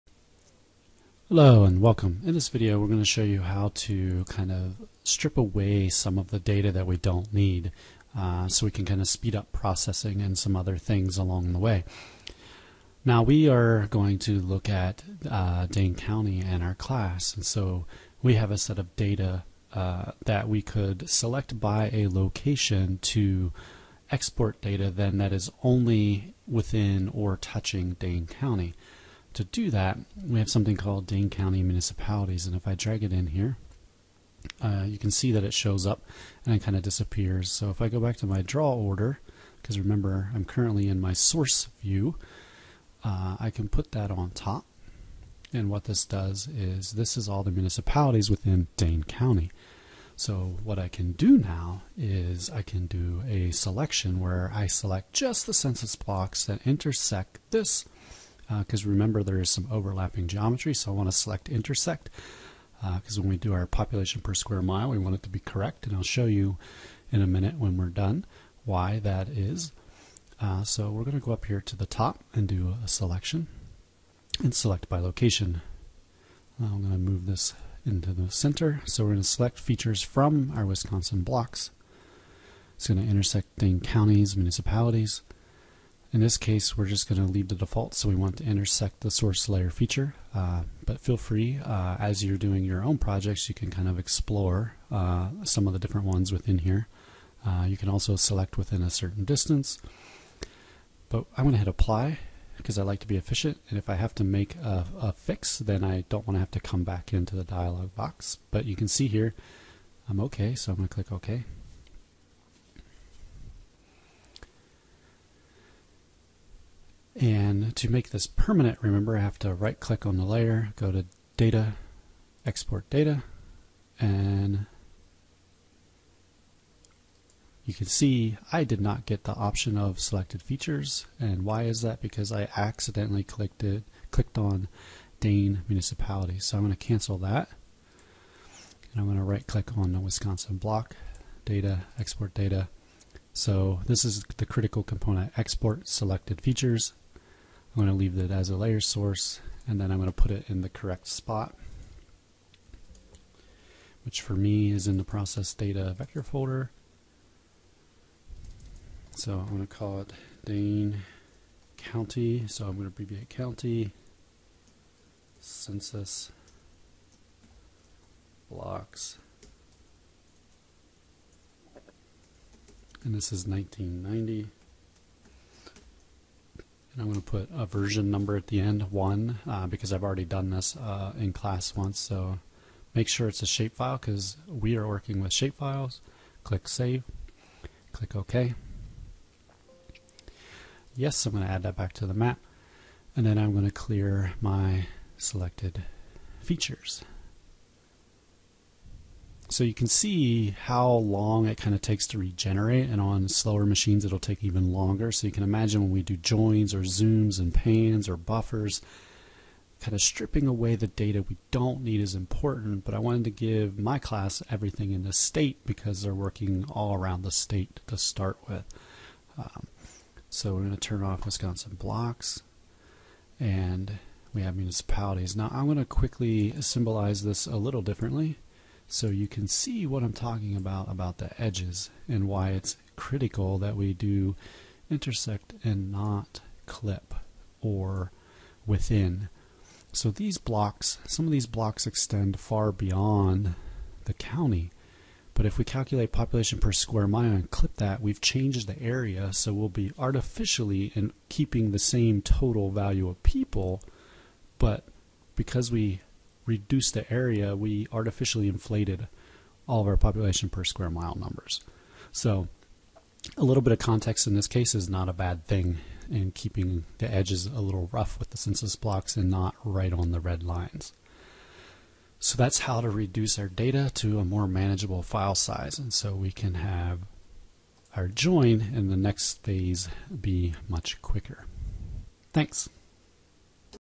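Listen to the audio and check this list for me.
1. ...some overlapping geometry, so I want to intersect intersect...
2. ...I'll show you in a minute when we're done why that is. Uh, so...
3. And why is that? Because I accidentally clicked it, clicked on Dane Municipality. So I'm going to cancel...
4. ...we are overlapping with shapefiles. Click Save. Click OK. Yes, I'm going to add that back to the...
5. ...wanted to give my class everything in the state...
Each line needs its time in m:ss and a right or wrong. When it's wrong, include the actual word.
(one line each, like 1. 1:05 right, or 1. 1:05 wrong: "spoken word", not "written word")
1. 0:59 wrong: "select", not "intersect"
2. 1:05 right
3. 2:11 right
4. 3:04 wrong: "working", not "overlapping"
5. 3:32 right.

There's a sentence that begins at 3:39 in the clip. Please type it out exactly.
Um, so we're going to turn off Wisconsin blocks and we have municipalities.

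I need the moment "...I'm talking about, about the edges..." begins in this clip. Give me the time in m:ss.
3:50.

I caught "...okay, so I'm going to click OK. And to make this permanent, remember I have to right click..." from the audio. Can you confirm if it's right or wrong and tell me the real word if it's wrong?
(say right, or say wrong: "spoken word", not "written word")
right.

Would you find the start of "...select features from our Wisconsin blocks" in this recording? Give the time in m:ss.
1:19.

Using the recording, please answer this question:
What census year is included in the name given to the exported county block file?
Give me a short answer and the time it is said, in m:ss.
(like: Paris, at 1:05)
1990, at 2:53.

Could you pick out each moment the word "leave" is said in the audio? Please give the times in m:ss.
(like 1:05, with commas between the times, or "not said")
1:27, 2:27.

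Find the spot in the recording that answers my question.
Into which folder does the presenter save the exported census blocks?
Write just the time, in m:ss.
2:35.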